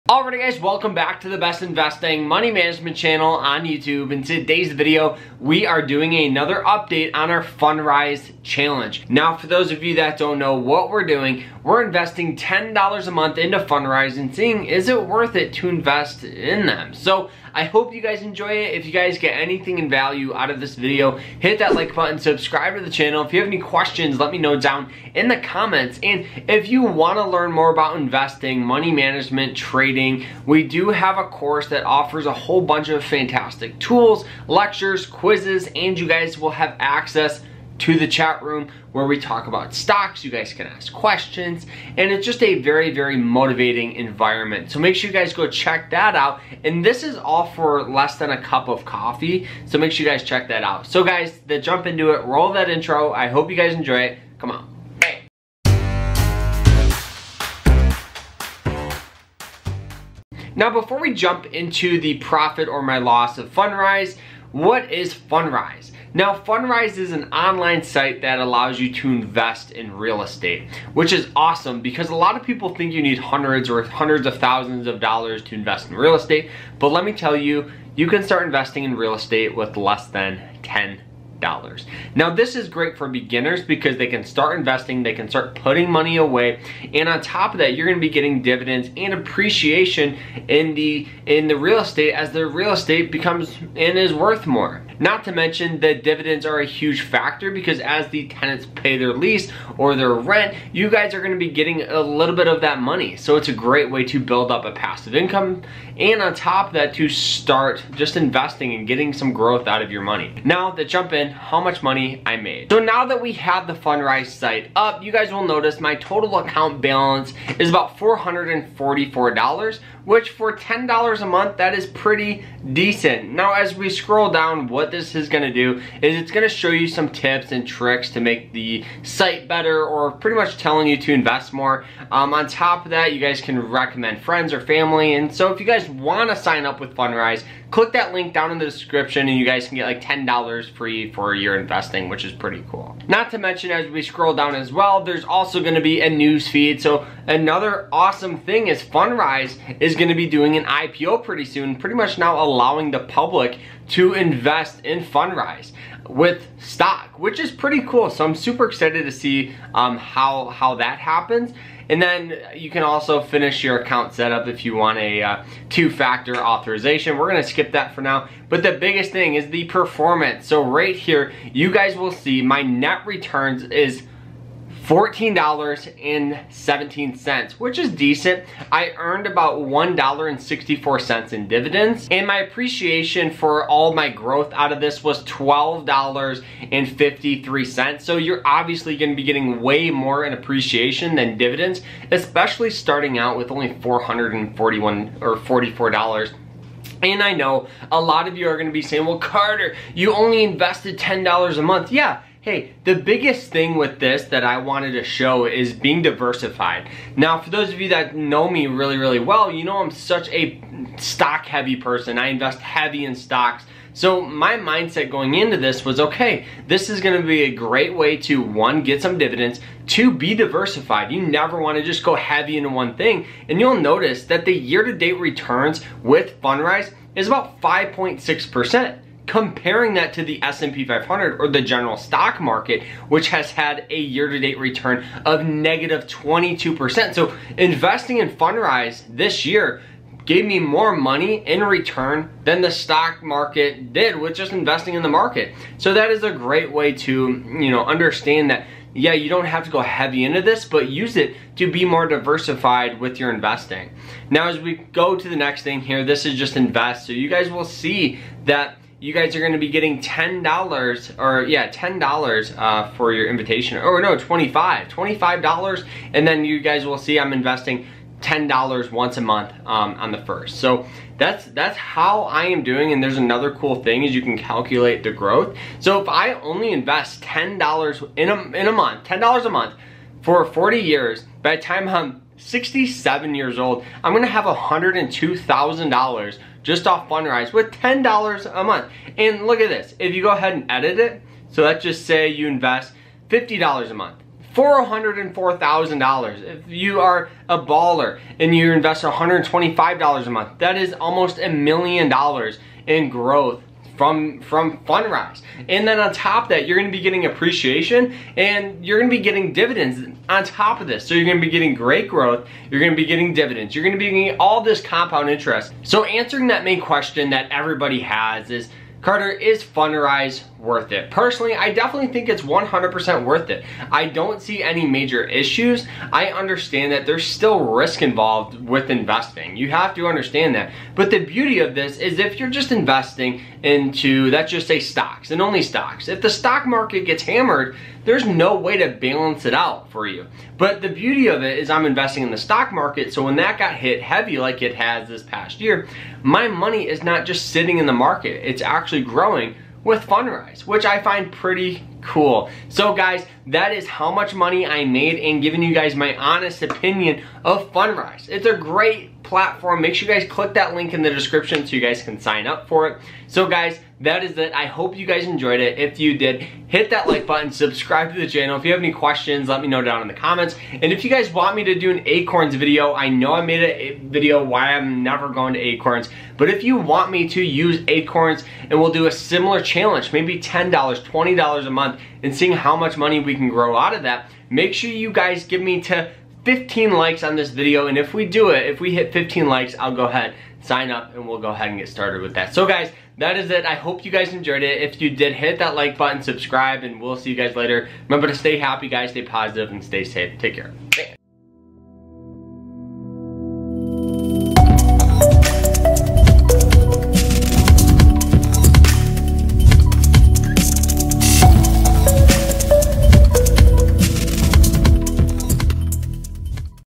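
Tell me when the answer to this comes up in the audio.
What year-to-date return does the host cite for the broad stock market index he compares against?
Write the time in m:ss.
3:55.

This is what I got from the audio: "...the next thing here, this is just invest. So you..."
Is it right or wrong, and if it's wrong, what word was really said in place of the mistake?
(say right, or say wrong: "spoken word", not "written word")
right.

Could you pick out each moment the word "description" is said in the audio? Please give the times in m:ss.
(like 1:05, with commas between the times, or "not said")
2:18, 6:01.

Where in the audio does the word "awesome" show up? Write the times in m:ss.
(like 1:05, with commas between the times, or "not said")
1:11, 2:27.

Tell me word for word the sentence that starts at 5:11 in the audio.
So you're gonna be getting great growth, you're gonna be getting dividends, you're gonna be getting all this compound interest.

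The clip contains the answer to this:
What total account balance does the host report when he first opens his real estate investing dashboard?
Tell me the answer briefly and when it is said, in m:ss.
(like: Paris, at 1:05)
$444, at 1:57.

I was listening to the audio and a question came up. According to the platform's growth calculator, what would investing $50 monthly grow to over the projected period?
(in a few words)
$404,000.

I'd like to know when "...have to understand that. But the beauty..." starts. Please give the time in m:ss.
5:29.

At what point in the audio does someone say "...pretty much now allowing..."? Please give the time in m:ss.
2:31.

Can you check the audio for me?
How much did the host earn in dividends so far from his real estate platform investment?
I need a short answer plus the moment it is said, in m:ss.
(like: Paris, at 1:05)
$1.64, at 2:59.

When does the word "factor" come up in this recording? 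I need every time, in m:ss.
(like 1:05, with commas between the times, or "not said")
1:37, 2:45.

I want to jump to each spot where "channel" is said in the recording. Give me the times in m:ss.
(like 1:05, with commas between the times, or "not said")
0:02, 0:22, 6:08.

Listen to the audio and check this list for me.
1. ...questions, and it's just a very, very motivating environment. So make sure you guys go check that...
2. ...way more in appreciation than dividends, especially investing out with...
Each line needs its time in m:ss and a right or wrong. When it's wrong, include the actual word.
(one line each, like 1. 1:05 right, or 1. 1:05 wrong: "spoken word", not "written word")
1. 0:40 right
2. 3:09 wrong: "starting", not "investing".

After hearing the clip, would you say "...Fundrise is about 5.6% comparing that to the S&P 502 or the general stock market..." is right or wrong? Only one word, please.
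wrong.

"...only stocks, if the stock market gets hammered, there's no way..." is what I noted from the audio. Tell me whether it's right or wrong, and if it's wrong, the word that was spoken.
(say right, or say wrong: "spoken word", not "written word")
right.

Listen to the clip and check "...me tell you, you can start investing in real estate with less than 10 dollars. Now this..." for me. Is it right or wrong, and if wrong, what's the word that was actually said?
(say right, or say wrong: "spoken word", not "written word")
right.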